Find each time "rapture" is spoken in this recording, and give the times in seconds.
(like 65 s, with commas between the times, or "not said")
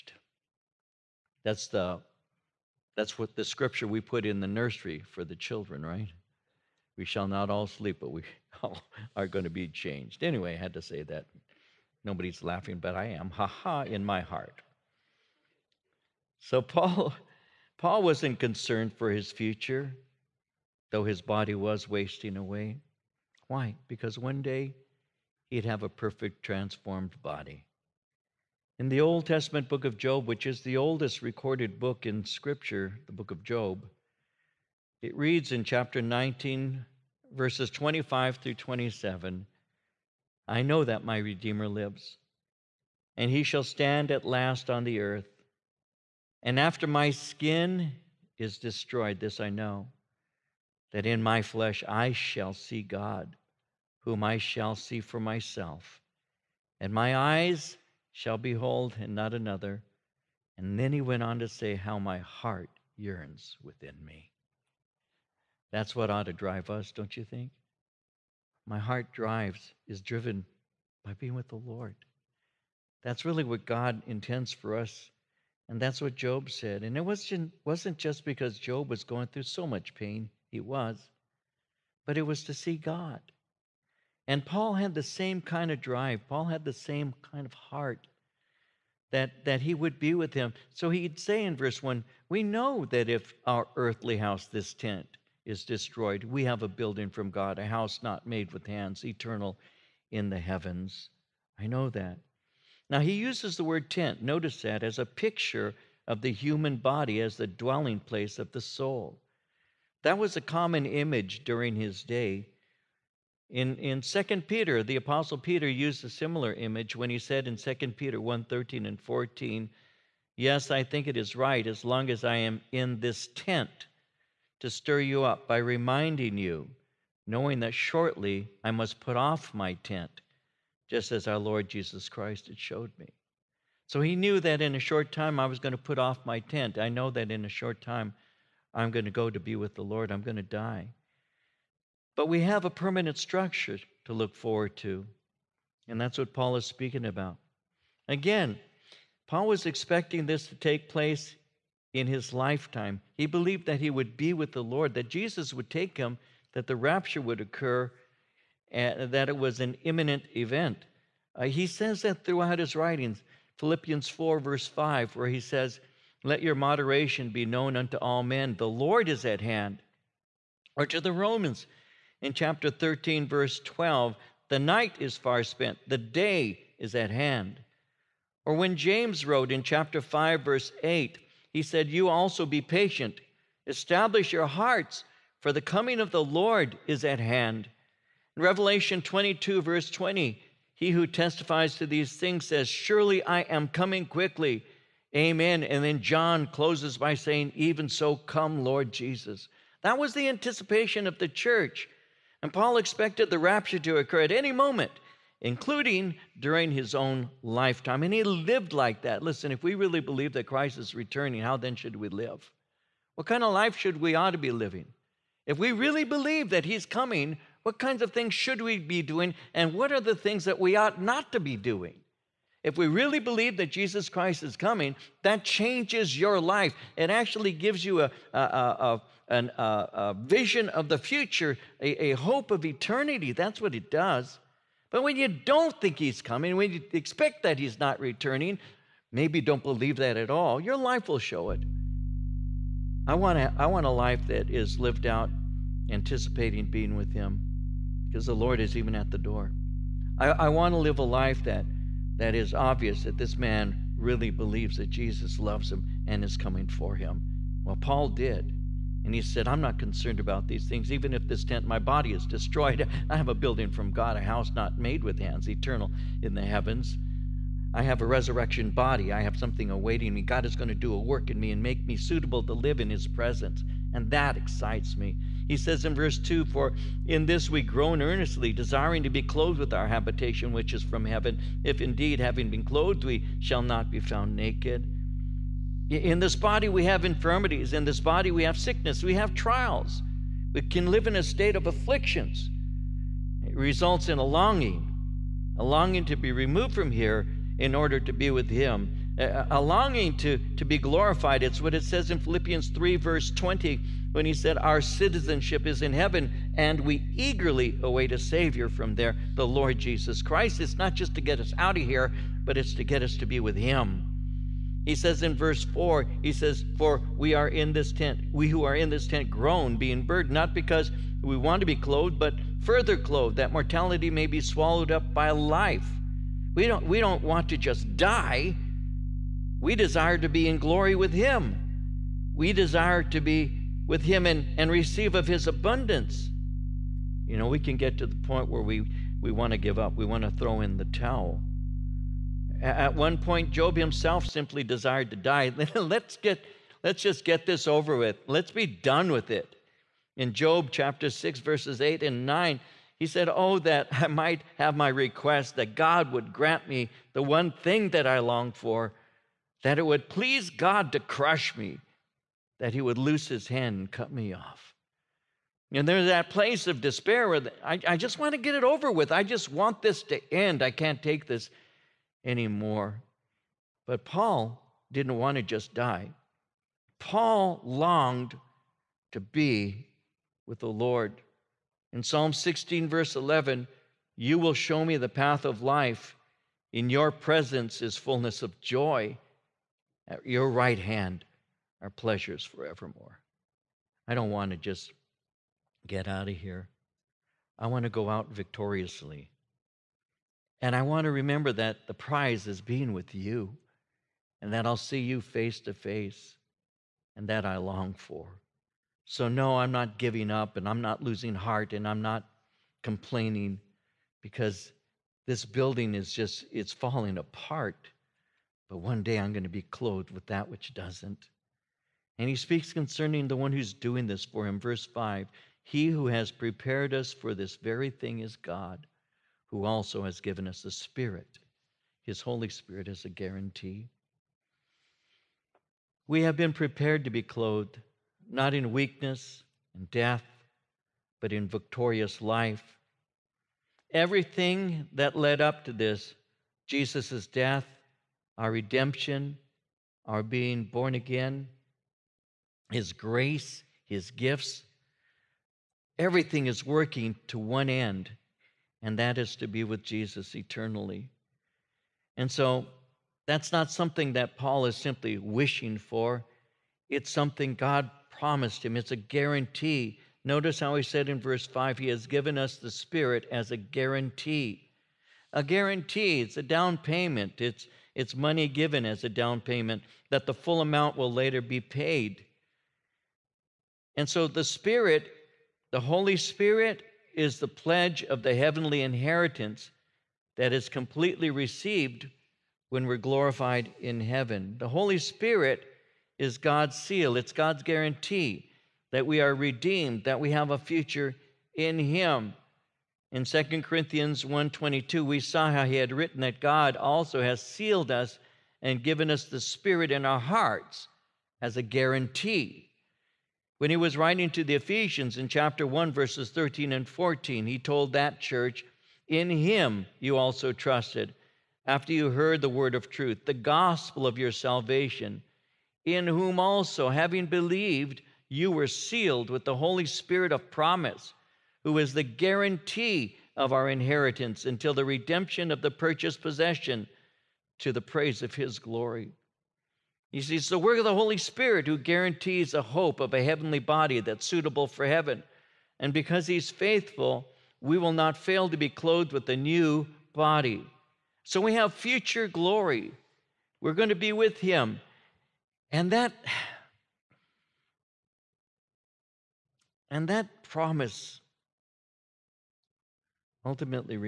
156 s, 203 s.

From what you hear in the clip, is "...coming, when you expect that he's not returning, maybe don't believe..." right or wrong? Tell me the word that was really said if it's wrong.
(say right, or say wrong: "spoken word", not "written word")
right.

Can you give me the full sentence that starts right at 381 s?
In Psalm 16, verse 11, you will show me the path of life.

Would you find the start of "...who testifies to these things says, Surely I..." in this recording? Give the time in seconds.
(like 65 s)
190 s.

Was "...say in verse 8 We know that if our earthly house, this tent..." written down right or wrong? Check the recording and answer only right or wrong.
wrong.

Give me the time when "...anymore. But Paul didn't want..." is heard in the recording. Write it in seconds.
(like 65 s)
372 s.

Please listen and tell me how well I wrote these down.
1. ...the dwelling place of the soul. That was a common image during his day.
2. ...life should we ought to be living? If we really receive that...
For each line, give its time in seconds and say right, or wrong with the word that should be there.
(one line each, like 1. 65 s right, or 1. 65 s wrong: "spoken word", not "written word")
1. 107 s right
2. 213 s wrong: "believe", not "receive".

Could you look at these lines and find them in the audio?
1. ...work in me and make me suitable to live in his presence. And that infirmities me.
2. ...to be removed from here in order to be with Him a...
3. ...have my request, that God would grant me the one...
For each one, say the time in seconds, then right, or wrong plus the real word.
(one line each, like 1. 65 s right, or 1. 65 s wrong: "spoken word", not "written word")
1. 271 s wrong: "excites", not "infirmities"
2. 296 s right
3. 354 s right.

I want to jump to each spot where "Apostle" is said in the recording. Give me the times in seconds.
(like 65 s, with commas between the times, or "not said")
114 s.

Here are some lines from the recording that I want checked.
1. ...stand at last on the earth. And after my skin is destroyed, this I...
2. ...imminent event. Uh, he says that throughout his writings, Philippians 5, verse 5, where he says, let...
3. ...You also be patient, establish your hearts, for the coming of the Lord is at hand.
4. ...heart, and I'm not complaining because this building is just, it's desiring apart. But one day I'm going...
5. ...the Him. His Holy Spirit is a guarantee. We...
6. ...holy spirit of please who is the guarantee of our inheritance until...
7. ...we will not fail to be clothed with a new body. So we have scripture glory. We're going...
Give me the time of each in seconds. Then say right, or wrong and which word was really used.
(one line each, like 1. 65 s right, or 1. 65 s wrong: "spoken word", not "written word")
1. 43 s right
2. 159 s wrong: "4", not "5"
3. 181 s right
4. 411 s wrong: "falling", not "desiring"
5. 430 s wrong: "Spirit", not "Him"
6. 529 s wrong: "promise", not "please"
7. 547 s wrong: "future", not "scripture".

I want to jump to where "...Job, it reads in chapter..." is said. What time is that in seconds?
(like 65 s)
33 s.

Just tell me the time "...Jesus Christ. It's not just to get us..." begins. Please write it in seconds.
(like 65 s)
309 s.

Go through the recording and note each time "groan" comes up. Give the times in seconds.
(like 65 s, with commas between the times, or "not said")
277 s, 319 s.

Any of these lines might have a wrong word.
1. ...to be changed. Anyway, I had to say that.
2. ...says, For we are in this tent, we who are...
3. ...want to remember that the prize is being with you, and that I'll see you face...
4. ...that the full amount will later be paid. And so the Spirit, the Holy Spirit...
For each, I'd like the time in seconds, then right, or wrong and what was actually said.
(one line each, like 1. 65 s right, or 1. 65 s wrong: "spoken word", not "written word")
1. 9 s right
2. 316 s right
3. 400 s right
4. 480 s right.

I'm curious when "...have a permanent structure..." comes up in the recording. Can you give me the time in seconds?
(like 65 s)
142 s.